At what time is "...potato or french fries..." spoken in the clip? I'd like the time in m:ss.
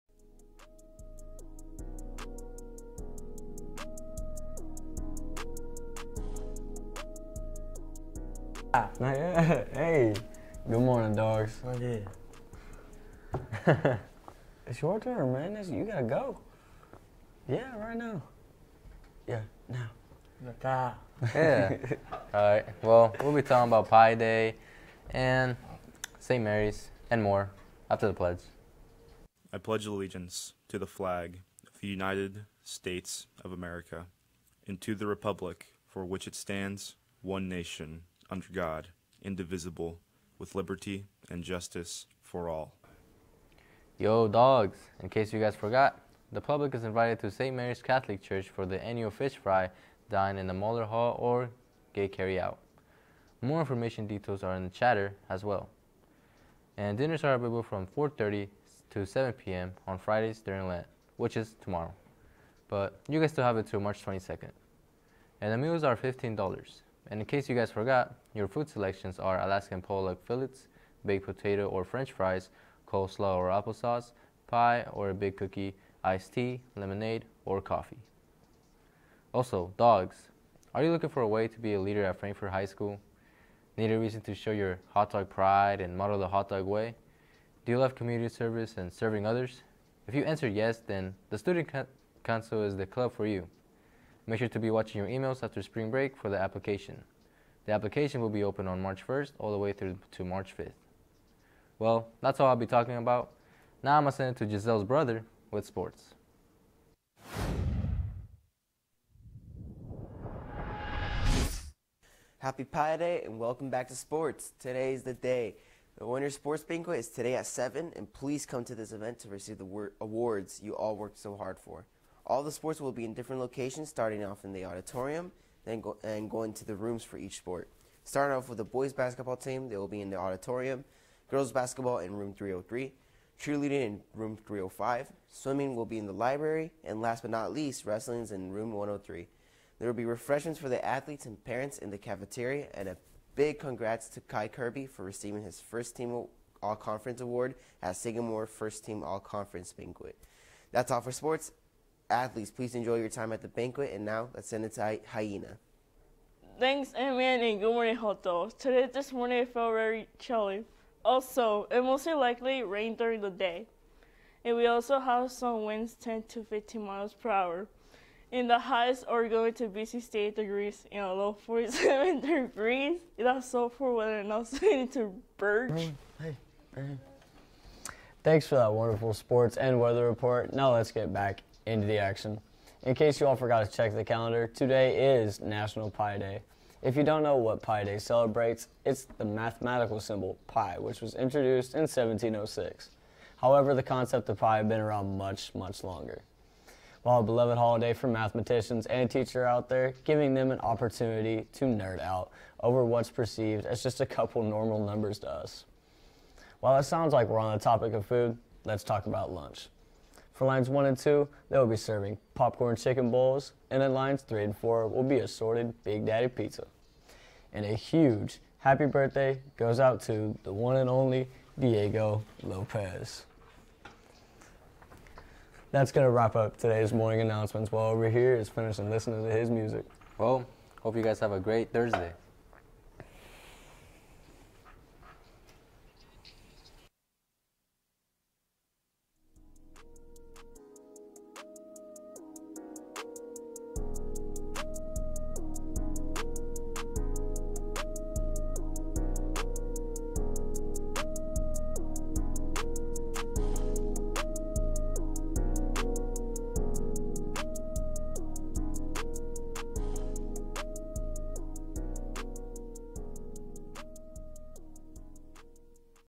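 1:11.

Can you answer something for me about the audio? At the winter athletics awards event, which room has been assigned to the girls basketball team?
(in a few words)
Room 303.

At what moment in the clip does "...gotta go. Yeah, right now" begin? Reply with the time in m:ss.
0:15.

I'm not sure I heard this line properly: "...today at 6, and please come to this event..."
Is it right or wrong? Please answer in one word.
wrong.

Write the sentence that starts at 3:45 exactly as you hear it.
That's going to wrap up today's morning announcements while over here is finishing listening to his music.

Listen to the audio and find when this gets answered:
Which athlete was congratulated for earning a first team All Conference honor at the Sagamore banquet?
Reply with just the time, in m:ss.
2:24.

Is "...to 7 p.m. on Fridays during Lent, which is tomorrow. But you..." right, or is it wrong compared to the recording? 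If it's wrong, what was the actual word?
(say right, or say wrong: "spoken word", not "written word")
right.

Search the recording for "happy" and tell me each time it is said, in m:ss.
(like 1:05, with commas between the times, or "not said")
1:52, 3:38.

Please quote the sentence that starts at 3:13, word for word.
However, the concept of pi had been around much, much longer.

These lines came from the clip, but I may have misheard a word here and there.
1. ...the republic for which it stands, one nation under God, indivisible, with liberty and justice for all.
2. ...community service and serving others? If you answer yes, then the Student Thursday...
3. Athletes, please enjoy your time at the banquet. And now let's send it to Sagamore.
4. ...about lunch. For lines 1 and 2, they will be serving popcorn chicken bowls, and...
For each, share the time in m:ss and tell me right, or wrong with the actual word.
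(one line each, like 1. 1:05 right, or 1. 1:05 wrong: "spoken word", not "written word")
1. 0:34 right
2. 1:27 wrong: "Council", not "Thursday"
3. 2:32 wrong: "Hyena", not "Sagamore"
4. 3:29 right.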